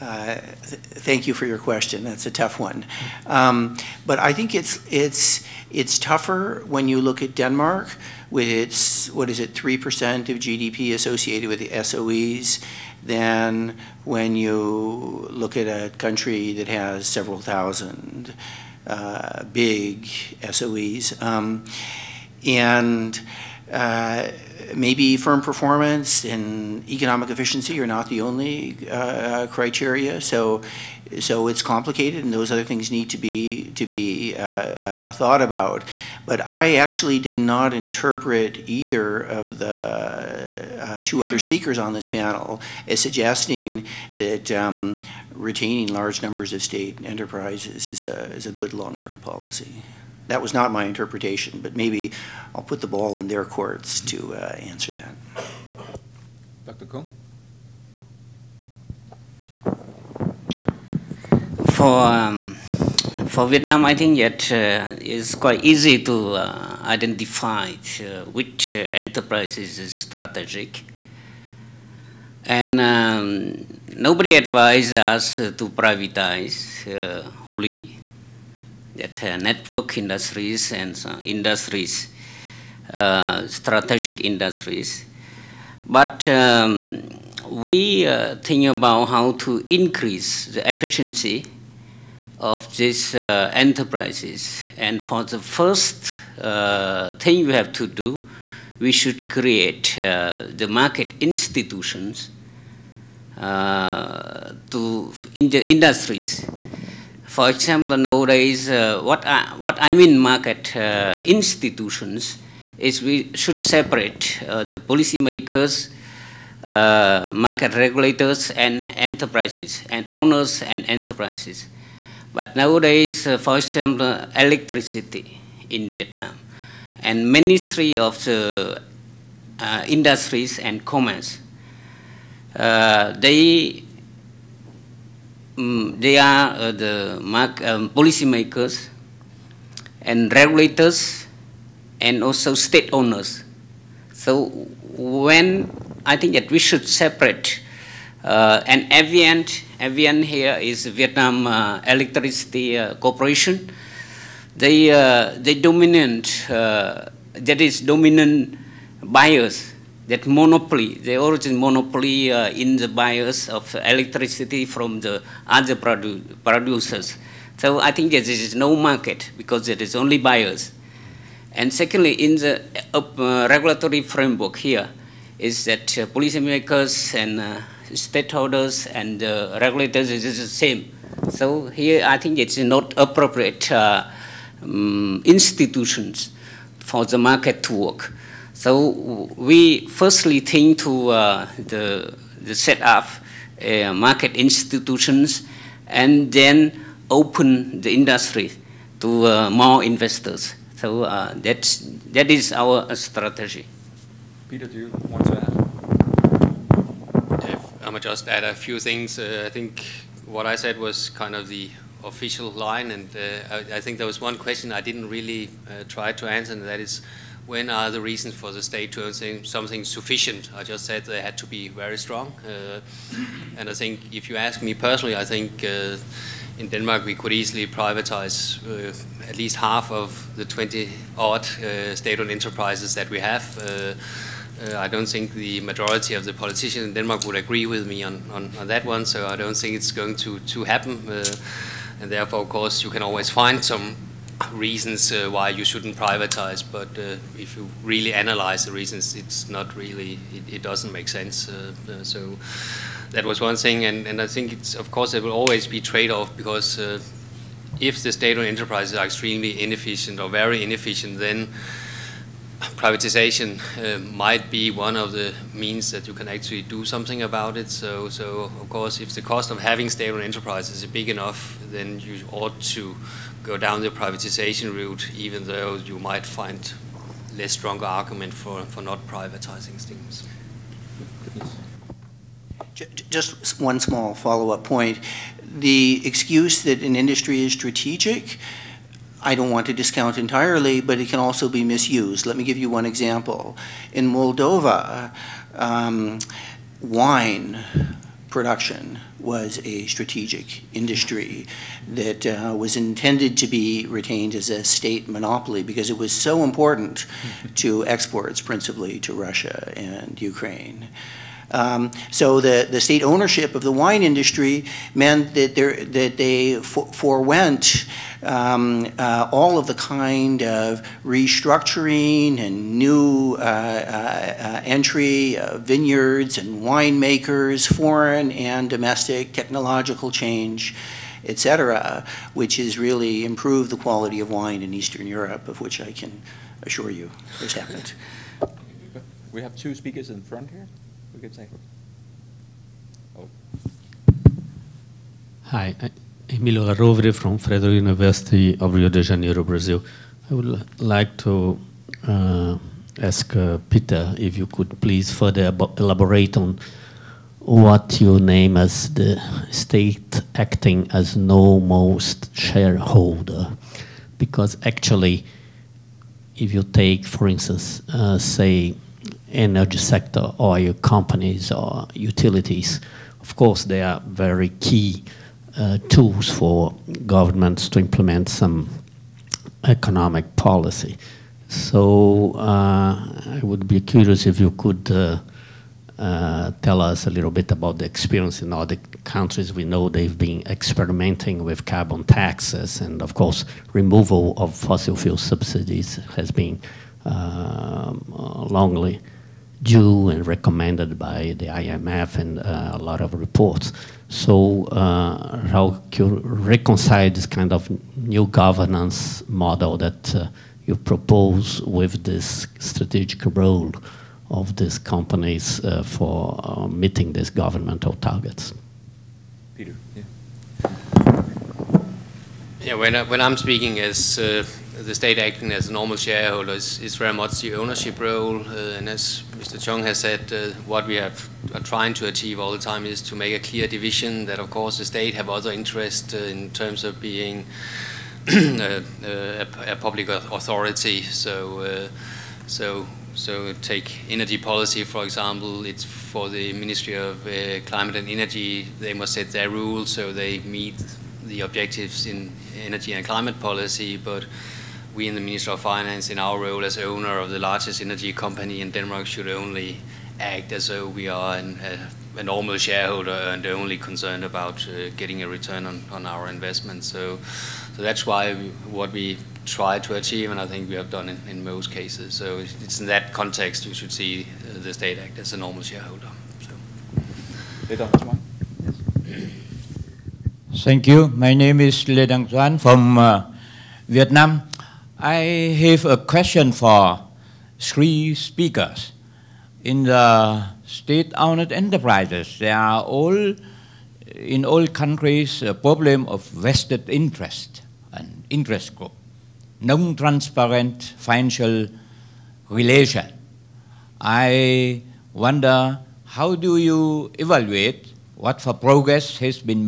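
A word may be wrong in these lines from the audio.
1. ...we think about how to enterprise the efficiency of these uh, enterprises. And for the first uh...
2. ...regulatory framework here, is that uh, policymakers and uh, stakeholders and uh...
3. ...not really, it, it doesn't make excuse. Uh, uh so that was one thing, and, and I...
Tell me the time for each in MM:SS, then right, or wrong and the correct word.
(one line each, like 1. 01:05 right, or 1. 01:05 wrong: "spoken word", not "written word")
1. 01:27 wrong: "increase", not "enterprise"
2. 02:53 right
3. 04:09 wrong: "sense", not "excuse".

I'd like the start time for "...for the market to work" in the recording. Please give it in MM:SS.
03:06.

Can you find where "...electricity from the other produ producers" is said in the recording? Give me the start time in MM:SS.
02:43.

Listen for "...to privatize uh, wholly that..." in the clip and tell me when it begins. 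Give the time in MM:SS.
01:15.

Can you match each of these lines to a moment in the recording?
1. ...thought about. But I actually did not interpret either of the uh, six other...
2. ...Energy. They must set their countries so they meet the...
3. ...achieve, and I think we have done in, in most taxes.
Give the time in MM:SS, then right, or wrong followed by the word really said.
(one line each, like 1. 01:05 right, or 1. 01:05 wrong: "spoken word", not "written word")
1. 00:35 wrong: "two", not "six"
2. 07:28 wrong: "rules", not "countries"
3. 07:49 wrong: "cases", not "taxes".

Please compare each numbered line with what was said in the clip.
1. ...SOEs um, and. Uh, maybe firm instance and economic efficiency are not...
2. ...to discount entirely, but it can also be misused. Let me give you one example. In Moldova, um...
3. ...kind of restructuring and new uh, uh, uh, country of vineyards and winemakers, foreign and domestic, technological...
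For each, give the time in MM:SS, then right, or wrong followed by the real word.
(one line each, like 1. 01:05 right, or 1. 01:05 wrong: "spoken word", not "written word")
1. 00:20 wrong: "performance", not "instance"
2. 04:49 right
3. 05:19 wrong: "entry", not "country".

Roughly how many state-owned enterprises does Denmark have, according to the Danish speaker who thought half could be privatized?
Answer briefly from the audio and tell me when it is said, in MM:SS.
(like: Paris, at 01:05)
20, at 03:50.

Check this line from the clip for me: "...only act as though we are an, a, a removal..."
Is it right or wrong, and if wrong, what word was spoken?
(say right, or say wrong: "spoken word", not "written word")
wrong: "normal", not "removal".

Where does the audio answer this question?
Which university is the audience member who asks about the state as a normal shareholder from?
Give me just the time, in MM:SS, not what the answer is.
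05:47.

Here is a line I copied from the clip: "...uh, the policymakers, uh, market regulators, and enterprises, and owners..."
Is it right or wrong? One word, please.
right.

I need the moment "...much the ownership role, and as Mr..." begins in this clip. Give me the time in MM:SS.
07:07.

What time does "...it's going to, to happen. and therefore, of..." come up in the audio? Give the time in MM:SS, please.
03:59.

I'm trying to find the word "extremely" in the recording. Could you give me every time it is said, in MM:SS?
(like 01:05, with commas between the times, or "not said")
04:19.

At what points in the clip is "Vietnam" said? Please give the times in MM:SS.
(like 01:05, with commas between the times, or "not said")
01:03, 02:05, 02:30, 08:03.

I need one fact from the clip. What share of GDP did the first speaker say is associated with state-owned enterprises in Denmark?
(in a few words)
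3 percent.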